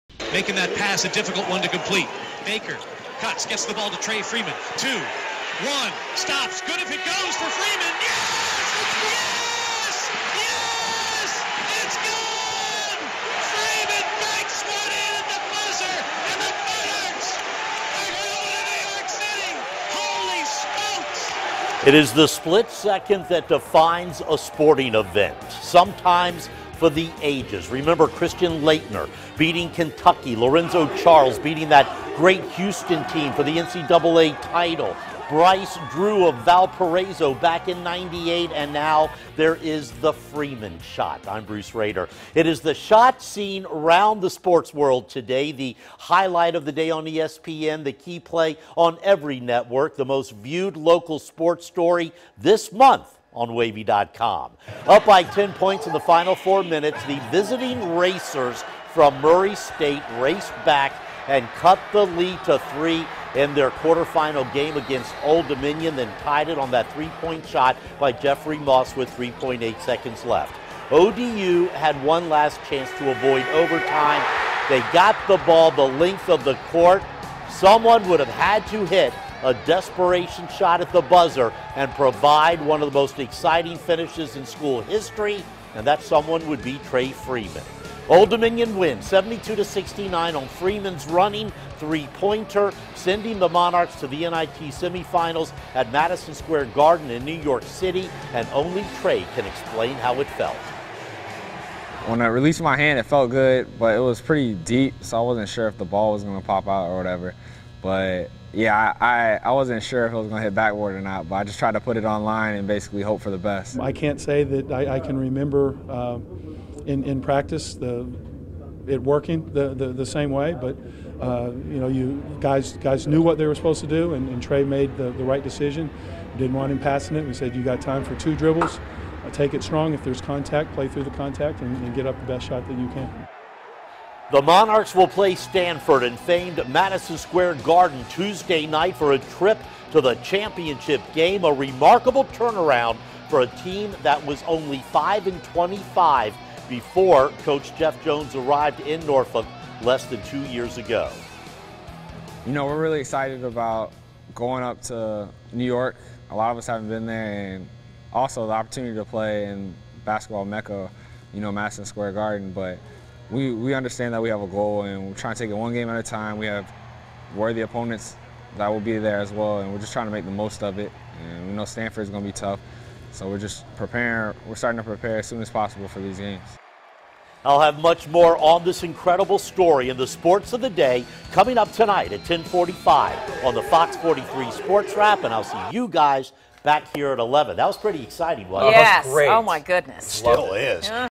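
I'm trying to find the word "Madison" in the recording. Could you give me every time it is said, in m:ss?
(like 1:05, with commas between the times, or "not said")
1:35, 2:16, 2:41.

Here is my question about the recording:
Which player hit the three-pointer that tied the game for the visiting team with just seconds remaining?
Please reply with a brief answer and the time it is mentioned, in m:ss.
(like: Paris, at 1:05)
Jeffrey Moss, at 1:08.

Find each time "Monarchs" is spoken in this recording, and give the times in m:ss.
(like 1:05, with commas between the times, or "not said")
0:16, 1:33, 2:14.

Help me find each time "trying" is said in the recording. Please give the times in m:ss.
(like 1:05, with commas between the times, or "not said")
2:45, 2:49.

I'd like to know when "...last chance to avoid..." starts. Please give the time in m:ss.
1:12.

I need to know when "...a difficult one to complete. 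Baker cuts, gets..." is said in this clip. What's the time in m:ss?
0:01.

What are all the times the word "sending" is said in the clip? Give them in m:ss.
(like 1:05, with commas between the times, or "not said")
1:32.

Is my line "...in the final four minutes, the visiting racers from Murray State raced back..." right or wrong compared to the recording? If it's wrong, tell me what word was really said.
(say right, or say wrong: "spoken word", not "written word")
right.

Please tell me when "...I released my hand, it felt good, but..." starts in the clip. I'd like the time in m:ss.
1:42.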